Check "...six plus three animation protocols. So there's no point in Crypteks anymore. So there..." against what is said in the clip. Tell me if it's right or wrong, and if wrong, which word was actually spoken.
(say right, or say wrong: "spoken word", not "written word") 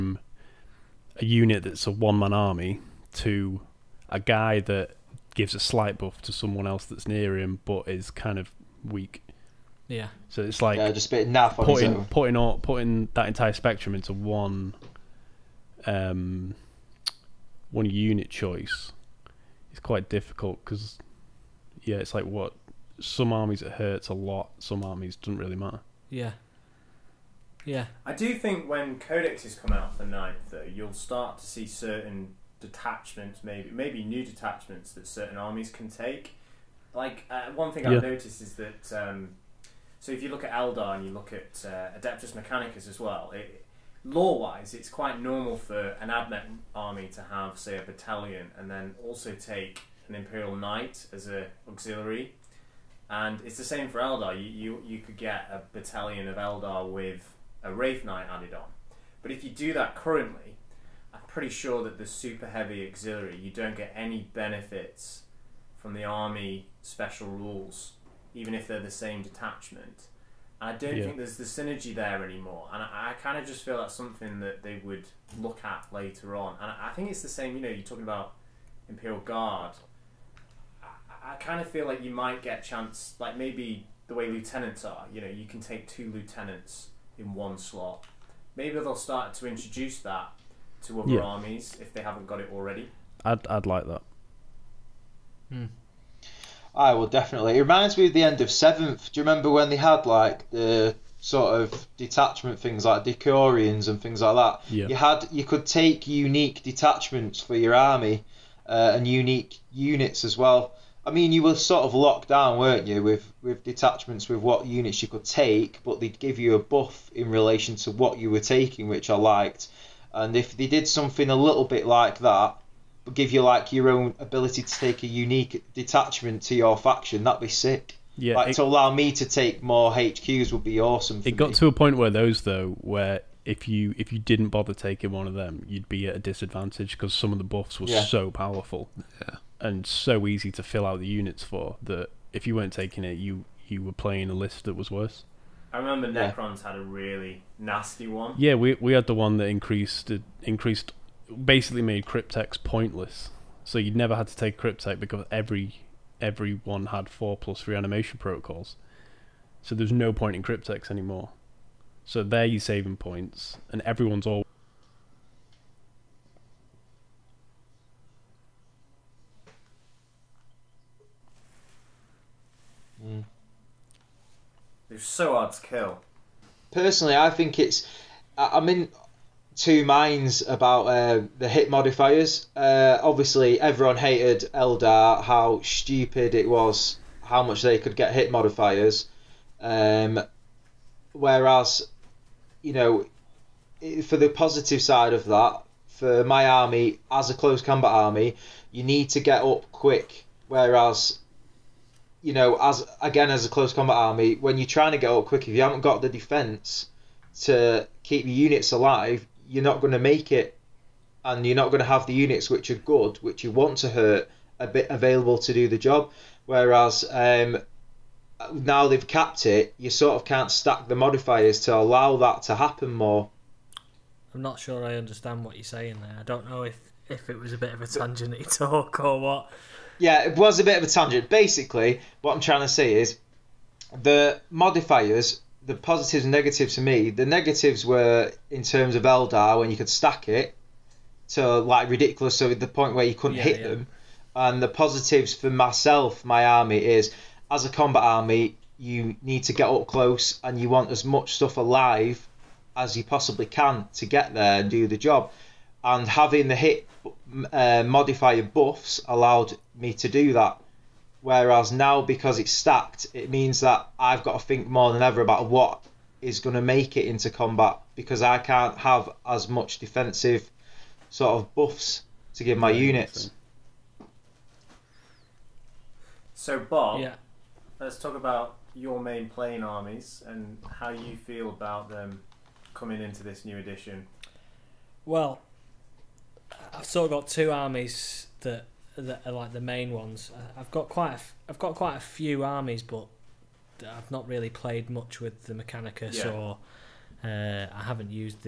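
wrong: "four", not "six".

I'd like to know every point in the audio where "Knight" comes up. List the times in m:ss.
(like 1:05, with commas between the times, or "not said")
0:50, 0:58.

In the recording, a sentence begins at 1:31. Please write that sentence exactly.
armies if they haven't got it already.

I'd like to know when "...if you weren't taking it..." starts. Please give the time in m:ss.
2:22.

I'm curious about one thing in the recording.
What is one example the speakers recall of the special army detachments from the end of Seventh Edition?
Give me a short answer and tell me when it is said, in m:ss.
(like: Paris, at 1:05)
Decurions, at 1:43.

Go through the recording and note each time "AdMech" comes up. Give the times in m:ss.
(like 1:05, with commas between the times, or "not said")
0:46.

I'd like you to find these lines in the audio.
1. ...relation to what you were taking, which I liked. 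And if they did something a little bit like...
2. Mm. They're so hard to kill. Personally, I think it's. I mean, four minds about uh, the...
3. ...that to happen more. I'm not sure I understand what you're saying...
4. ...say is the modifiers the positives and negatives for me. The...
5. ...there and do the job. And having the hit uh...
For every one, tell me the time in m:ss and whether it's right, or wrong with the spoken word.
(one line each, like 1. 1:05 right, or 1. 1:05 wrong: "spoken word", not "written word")
1. 1:57 right
2. 2:53 wrong: "two", not "four"
3. 3:42 right
4. 3:52 right
5. 4:14 right.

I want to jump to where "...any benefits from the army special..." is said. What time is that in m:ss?
1:03.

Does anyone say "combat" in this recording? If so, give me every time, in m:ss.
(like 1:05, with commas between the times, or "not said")
3:17, 3:23, 4:07, 4:27.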